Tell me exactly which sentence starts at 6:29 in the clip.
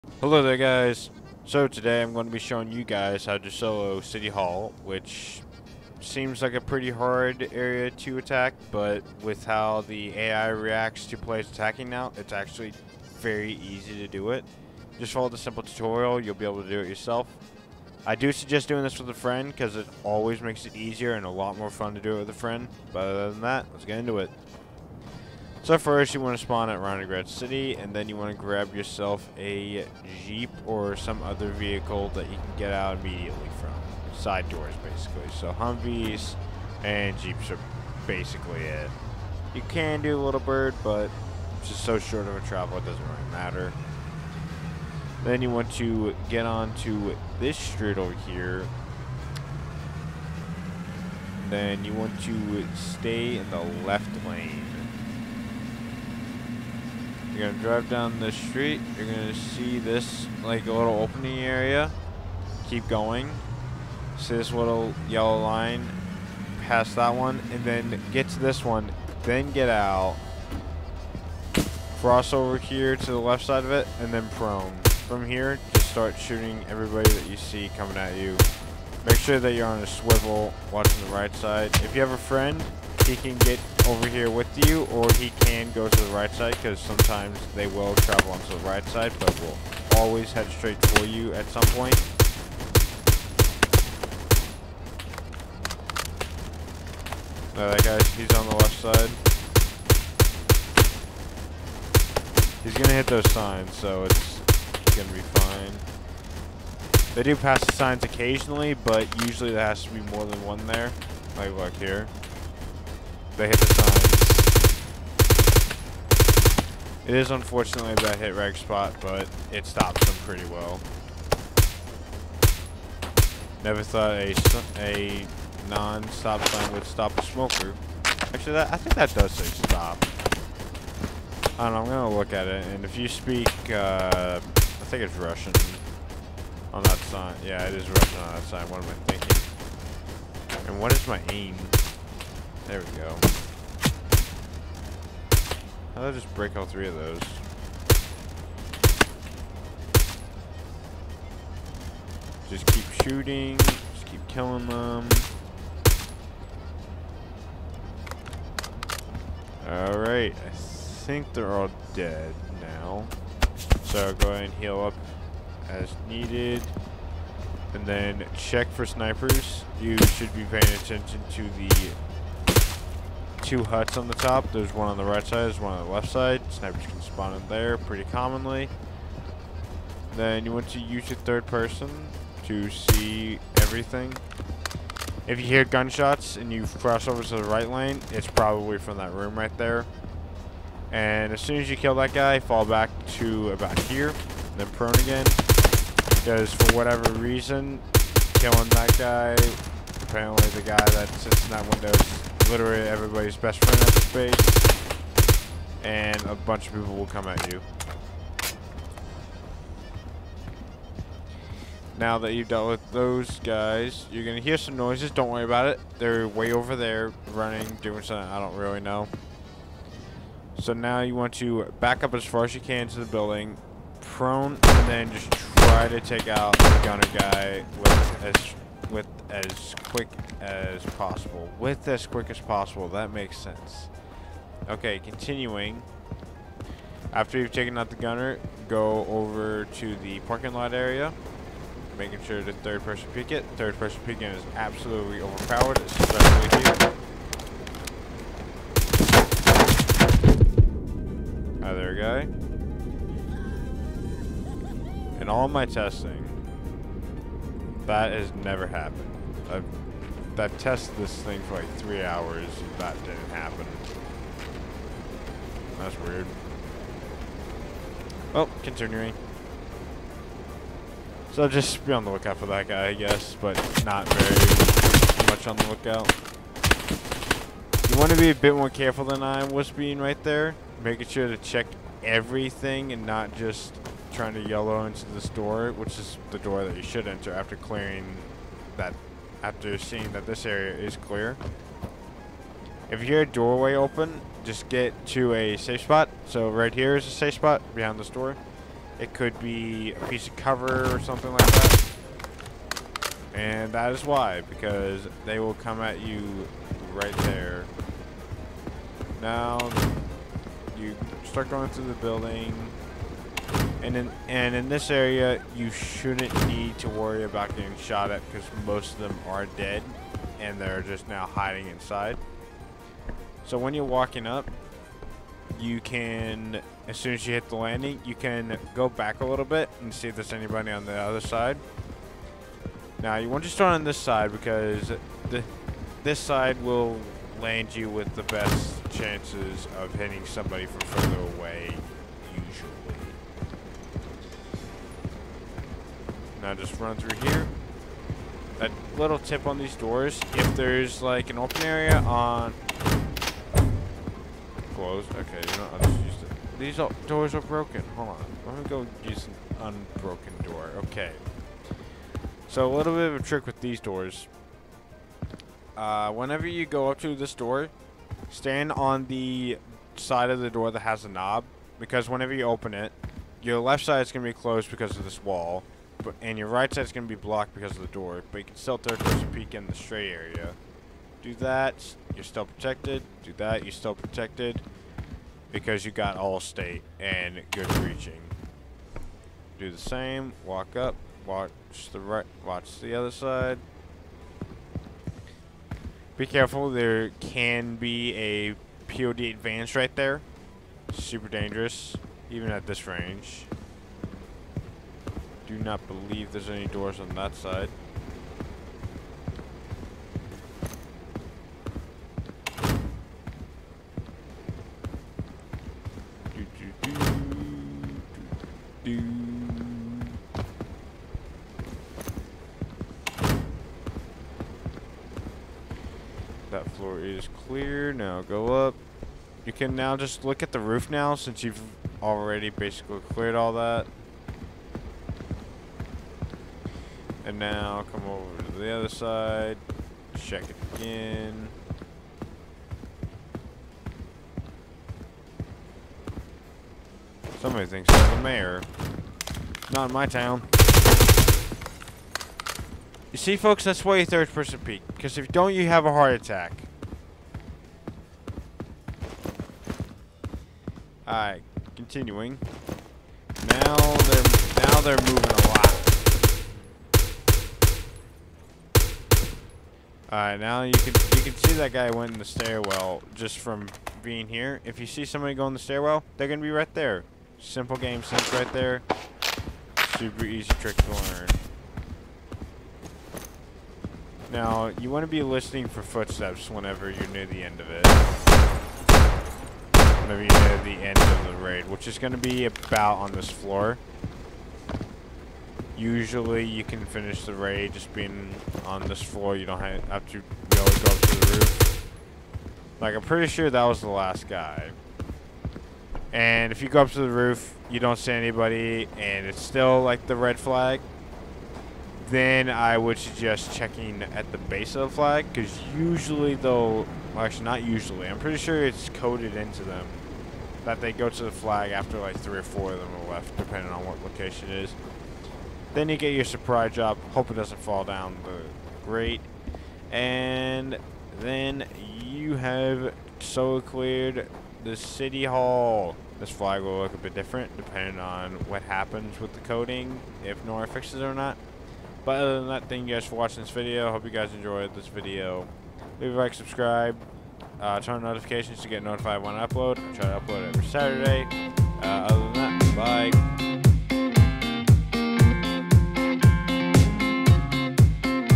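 Do the same, walk up, watch the right, watch the other side.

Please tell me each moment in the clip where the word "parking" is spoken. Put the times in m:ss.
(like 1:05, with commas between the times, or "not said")
4:00.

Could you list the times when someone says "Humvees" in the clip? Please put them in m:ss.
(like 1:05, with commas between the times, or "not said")
0:35.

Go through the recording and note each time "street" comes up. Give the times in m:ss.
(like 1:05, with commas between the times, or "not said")
0:47, 0:58.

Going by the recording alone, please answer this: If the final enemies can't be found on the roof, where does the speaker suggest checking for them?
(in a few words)
Base of the flag.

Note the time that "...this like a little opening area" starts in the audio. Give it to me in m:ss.
0:59.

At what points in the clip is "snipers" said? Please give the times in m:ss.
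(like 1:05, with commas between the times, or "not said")
2:48, 2:56.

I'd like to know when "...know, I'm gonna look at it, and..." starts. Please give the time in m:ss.
2:11.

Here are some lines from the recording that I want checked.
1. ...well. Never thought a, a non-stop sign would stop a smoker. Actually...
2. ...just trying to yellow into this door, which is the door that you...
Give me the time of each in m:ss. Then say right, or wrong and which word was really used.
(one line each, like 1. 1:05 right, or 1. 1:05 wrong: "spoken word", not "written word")
1. 2:00 right
2. 4:43 right.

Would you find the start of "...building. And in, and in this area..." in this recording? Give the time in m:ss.
5:11.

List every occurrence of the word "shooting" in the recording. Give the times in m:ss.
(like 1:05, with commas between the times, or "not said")
1:16, 2:33.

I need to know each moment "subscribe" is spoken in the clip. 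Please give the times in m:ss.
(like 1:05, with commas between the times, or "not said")
9:06.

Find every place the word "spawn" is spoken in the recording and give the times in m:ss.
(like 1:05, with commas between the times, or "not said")
0:26, 2:57.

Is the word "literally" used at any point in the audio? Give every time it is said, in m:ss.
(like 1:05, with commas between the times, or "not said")
3:22.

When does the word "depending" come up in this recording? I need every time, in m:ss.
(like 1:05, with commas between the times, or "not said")
8:43, 8:57.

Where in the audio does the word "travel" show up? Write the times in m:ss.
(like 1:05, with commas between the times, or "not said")
0:42, 1:27.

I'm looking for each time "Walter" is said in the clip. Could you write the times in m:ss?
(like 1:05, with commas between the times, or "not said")
not said.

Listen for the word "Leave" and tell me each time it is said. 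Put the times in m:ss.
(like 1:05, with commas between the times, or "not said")
9:05.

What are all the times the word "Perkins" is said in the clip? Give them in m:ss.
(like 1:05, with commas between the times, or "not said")
not said.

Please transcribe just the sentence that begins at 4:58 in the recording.
It could be a piece of cover or something like that.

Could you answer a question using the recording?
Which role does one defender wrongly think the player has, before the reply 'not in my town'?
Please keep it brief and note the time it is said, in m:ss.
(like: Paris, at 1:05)
The mayor, at 7:28.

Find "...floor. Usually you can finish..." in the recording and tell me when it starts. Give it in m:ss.
8:13.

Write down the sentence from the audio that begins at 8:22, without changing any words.
Like, I'm pretty sure that was the last guy.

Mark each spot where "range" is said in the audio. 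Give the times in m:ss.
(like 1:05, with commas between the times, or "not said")
6:42.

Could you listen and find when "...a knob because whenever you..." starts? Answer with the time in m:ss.
6:11.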